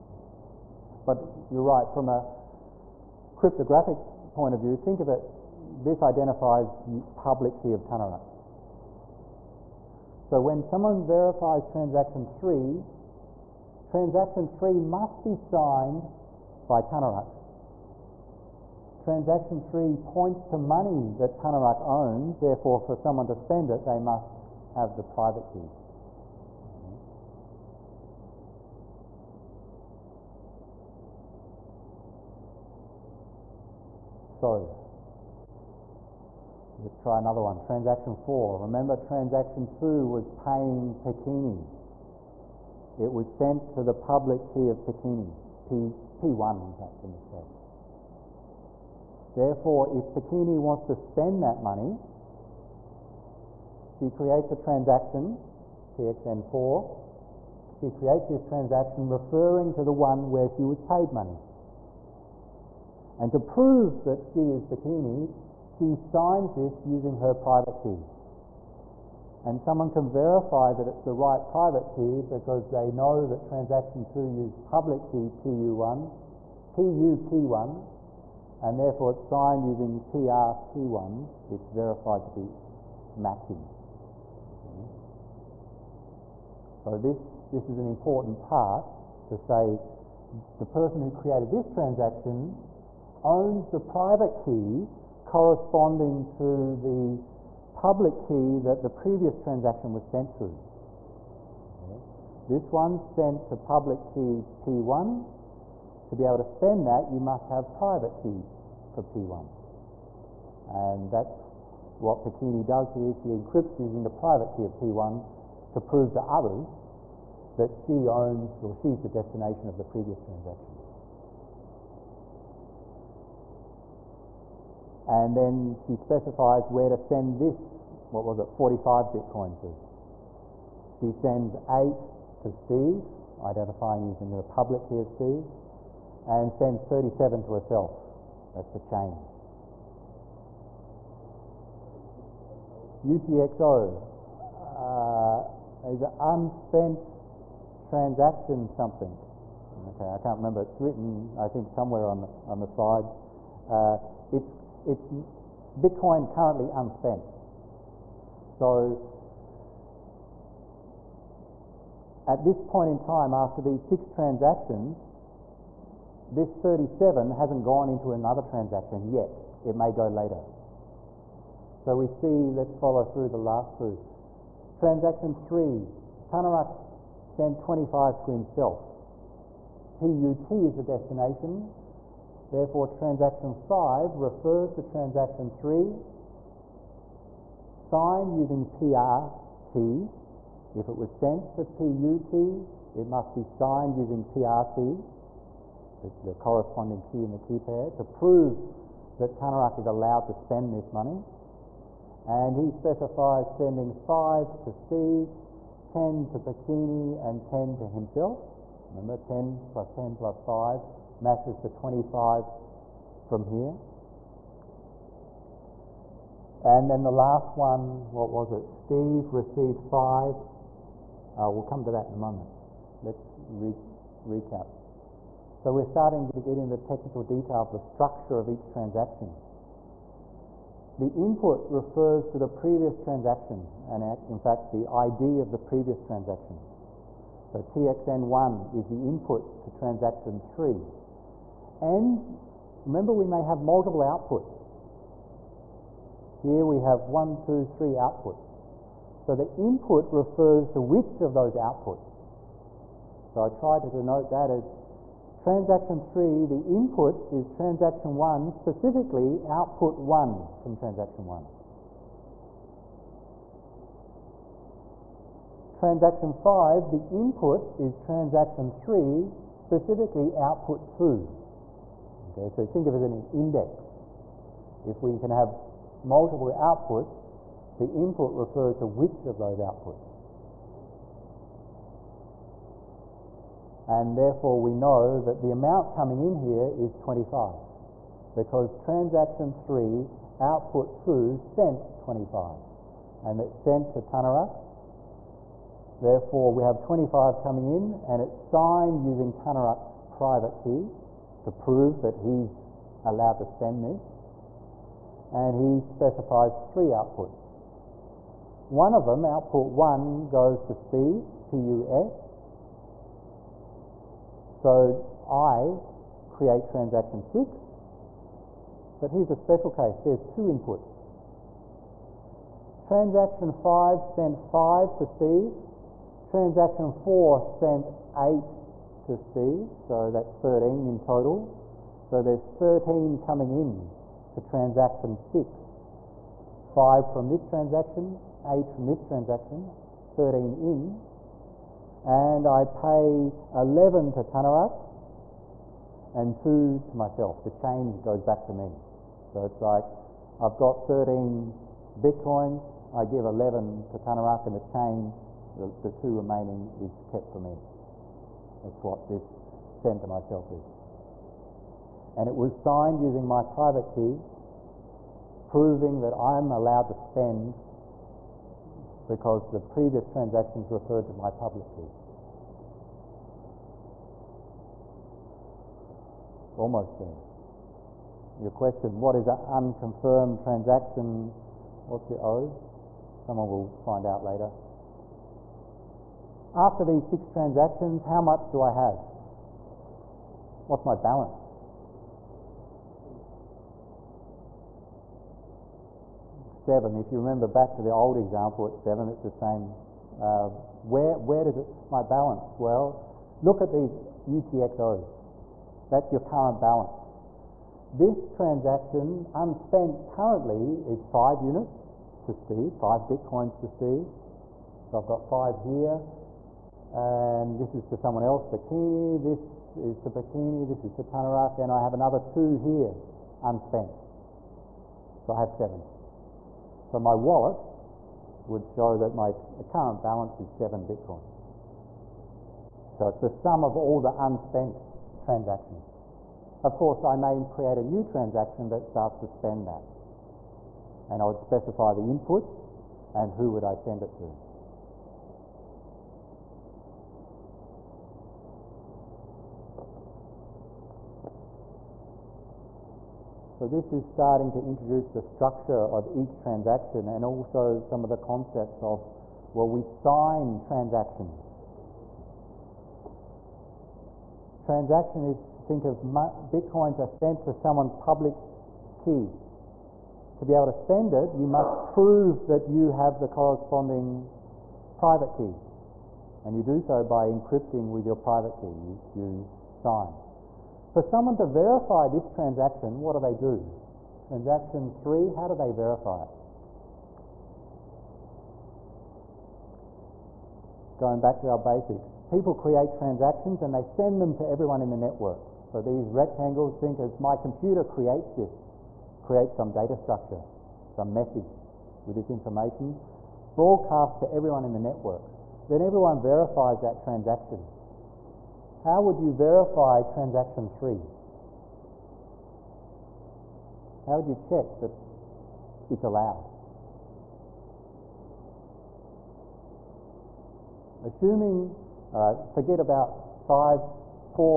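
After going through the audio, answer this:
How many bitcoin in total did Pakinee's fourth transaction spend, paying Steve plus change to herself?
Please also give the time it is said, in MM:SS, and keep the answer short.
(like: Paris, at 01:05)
45, at 02:08.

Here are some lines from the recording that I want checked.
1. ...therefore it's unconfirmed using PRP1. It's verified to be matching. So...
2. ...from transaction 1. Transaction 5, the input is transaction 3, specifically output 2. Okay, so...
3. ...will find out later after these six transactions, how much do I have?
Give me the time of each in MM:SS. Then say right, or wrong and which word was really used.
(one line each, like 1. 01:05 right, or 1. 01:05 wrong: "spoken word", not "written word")
1. 01:18 wrong: "signed", not "unconfirmed"
2. 04:20 right
3. 06:23 right.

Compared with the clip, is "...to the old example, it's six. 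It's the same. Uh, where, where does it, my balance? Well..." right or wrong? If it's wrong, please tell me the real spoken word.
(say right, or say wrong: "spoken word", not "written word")
wrong: "seven", not "six".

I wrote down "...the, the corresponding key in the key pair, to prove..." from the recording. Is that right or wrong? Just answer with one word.
right.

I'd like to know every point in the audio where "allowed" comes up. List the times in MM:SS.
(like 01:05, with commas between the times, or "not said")
03:19, 05:03, 06:06, 08:36.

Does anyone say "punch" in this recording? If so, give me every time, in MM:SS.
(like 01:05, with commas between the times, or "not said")
not said.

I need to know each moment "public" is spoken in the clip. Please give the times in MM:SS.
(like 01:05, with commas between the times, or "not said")
00:07, 00:43, 01:14, 01:37, 01:43, 02:14, 06:11, 07:47.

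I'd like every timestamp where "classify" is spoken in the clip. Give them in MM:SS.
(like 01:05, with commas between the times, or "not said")
not said.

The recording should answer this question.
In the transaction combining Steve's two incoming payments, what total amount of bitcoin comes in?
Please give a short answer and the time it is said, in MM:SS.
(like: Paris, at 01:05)
13, at 05:30.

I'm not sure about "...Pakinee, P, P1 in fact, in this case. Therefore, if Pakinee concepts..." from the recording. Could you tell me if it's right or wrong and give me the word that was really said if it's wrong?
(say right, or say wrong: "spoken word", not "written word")
wrong: "wants", not "concepts".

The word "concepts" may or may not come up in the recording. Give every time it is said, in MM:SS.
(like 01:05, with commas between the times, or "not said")
07:38.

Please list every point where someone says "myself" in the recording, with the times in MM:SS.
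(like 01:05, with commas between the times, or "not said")
05:46, 06:00.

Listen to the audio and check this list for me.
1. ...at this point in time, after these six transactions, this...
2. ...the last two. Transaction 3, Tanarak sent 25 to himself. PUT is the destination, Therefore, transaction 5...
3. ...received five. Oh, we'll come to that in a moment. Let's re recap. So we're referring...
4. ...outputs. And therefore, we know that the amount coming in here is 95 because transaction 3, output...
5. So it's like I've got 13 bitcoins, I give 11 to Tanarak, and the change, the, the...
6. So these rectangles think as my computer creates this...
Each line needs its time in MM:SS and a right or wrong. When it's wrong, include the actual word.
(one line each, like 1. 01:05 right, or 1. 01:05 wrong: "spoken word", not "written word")
1. 02:42 right
2. 02:53 right
3. 03:39 wrong: "starting", not "referring"
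4. 04:39 wrong: "25", not "95"
5. 05:49 right
6. 08:15 right.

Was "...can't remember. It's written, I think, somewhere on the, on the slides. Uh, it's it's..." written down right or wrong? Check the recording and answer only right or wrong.
right.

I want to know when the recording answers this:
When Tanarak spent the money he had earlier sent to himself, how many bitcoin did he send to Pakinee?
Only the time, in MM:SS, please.
03:25.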